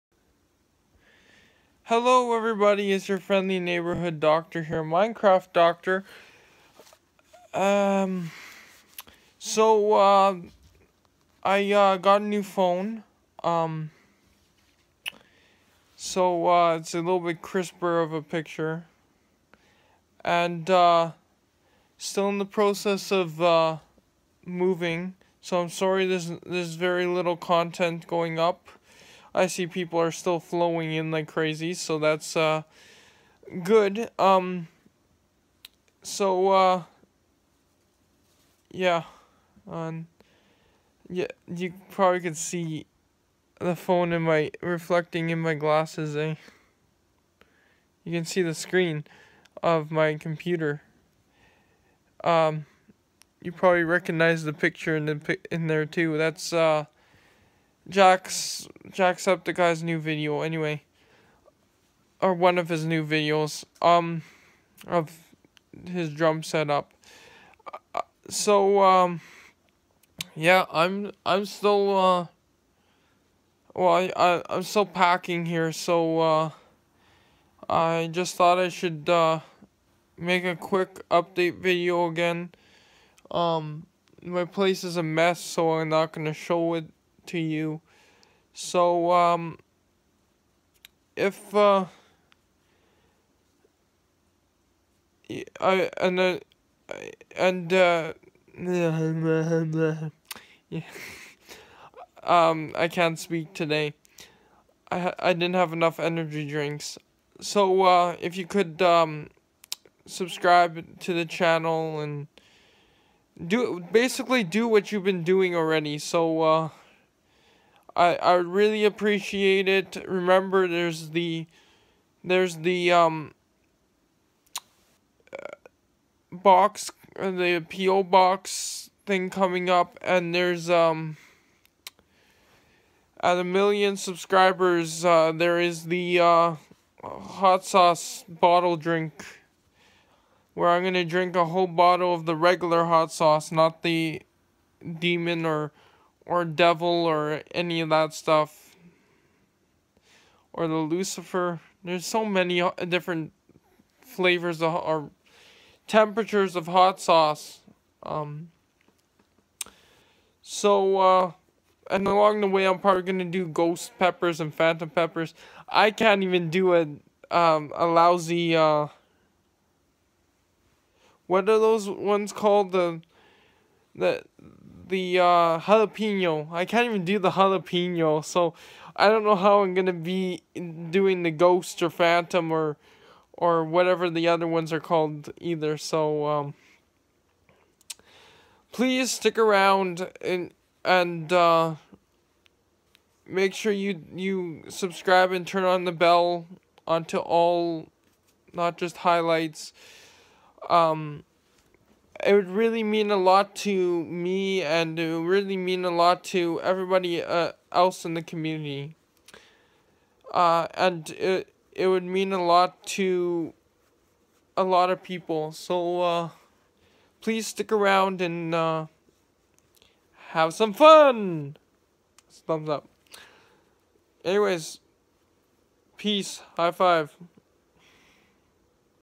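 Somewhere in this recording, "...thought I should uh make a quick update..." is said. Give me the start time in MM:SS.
01:18.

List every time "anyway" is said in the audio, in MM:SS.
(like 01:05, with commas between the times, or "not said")
01:00, 03:44.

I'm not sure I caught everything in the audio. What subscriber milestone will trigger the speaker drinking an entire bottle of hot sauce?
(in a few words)
1,000,000.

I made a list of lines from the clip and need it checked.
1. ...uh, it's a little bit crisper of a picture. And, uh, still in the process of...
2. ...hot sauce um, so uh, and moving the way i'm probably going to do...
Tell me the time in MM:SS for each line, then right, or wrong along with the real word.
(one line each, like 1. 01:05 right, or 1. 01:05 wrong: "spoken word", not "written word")
1. 00:16 right
2. 02:36 wrong: "along", not "moving".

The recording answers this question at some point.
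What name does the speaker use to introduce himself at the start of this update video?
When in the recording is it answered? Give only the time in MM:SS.
00:04.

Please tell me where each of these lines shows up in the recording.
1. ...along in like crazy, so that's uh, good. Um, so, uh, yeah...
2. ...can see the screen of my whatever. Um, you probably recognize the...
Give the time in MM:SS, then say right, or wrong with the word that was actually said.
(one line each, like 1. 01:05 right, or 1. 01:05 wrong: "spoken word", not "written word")
1. 00:30 wrong: "flowing", not "along"
2. 00:48 wrong: "computer", not "whatever".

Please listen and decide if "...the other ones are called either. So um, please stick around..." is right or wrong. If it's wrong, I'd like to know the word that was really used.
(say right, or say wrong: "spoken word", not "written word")
right.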